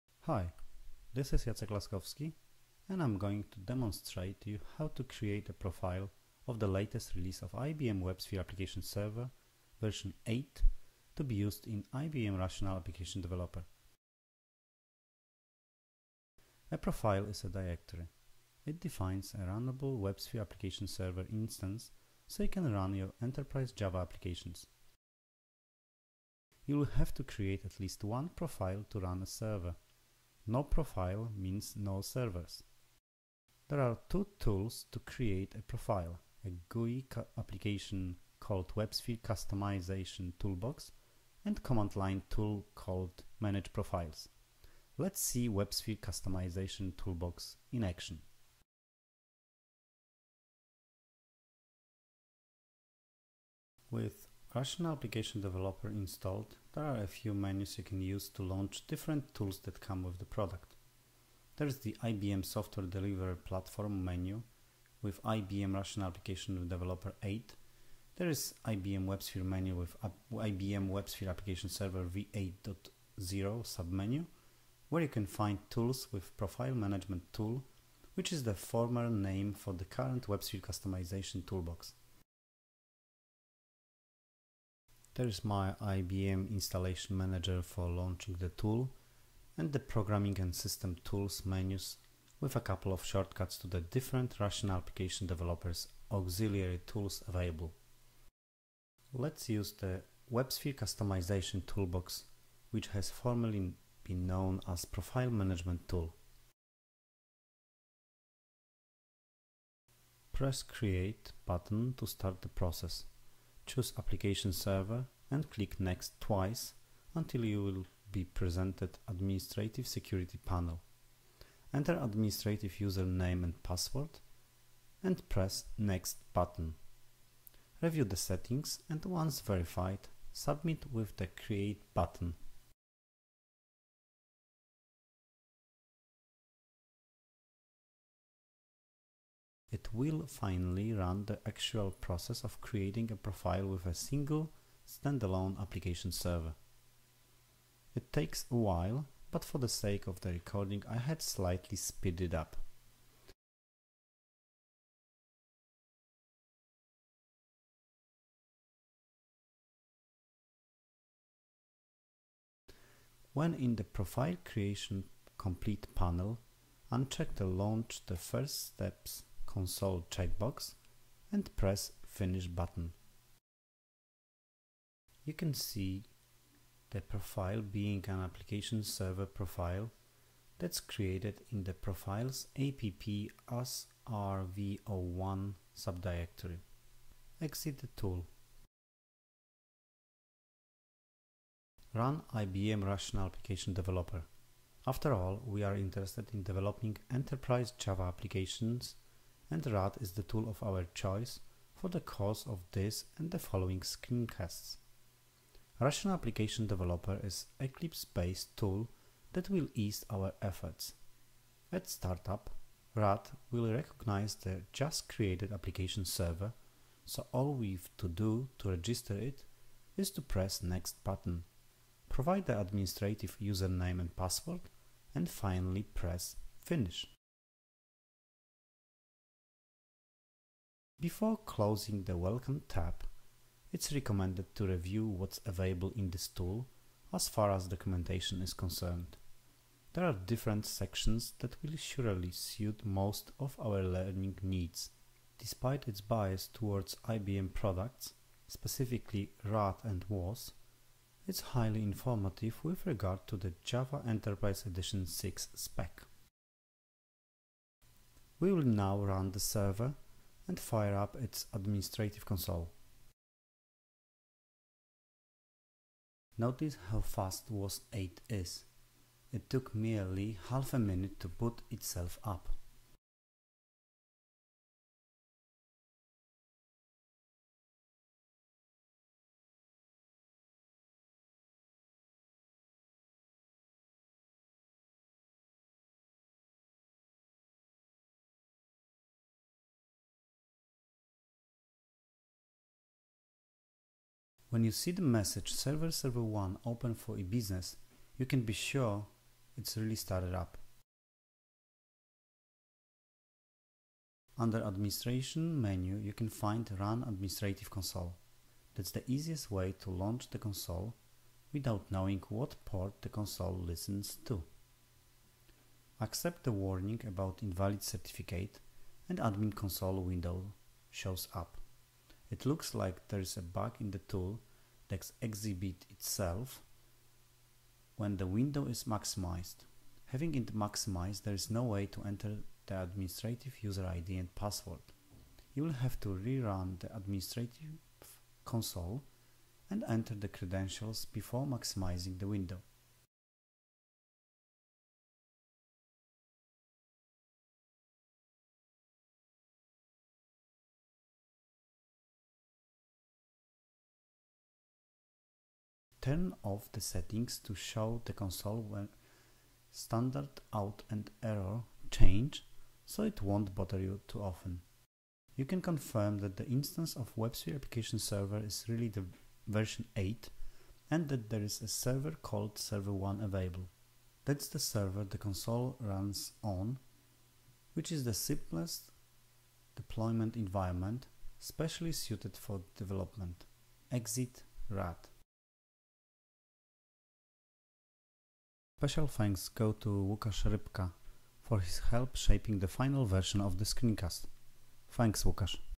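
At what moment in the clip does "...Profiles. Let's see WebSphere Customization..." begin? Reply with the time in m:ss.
0:43.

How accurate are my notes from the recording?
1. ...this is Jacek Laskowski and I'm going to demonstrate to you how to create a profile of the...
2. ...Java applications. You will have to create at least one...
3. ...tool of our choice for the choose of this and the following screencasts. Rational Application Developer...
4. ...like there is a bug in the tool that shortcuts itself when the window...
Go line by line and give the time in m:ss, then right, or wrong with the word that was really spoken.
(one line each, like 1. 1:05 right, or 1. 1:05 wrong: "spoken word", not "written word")
1. 0:01 right
2. 0:23 right
3. 3:20 wrong: "course", not "choose"
4. 5:22 wrong: "exhibits", not "shortcuts".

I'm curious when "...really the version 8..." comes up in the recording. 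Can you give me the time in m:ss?
6:08.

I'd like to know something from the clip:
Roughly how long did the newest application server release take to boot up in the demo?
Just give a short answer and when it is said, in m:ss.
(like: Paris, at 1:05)
half a minute, at 4:30.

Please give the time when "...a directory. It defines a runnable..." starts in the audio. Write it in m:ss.
0:17.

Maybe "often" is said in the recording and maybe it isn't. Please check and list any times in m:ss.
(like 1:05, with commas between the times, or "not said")
6:04.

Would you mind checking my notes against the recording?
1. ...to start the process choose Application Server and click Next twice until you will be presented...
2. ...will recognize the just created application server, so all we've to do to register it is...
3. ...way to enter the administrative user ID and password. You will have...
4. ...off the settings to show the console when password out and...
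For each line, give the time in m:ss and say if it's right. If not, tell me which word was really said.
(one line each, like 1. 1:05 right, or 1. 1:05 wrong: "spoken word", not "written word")
1. 1:51 right
2. 3:33 right
3. 5:31 right
4. 5:56 wrong: "standard", not "password".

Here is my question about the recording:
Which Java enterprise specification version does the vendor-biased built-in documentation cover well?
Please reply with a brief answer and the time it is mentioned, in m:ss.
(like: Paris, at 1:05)
Java Enterprise Edition 6, at 4:13.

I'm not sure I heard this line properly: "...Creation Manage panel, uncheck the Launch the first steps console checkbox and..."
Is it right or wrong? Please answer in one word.
wrong.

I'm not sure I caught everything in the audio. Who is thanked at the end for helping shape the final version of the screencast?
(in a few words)
Łukasz Rybka.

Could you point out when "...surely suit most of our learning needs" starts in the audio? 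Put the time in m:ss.
4:01.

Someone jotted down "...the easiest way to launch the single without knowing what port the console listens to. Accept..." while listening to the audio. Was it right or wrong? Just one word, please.
wrong.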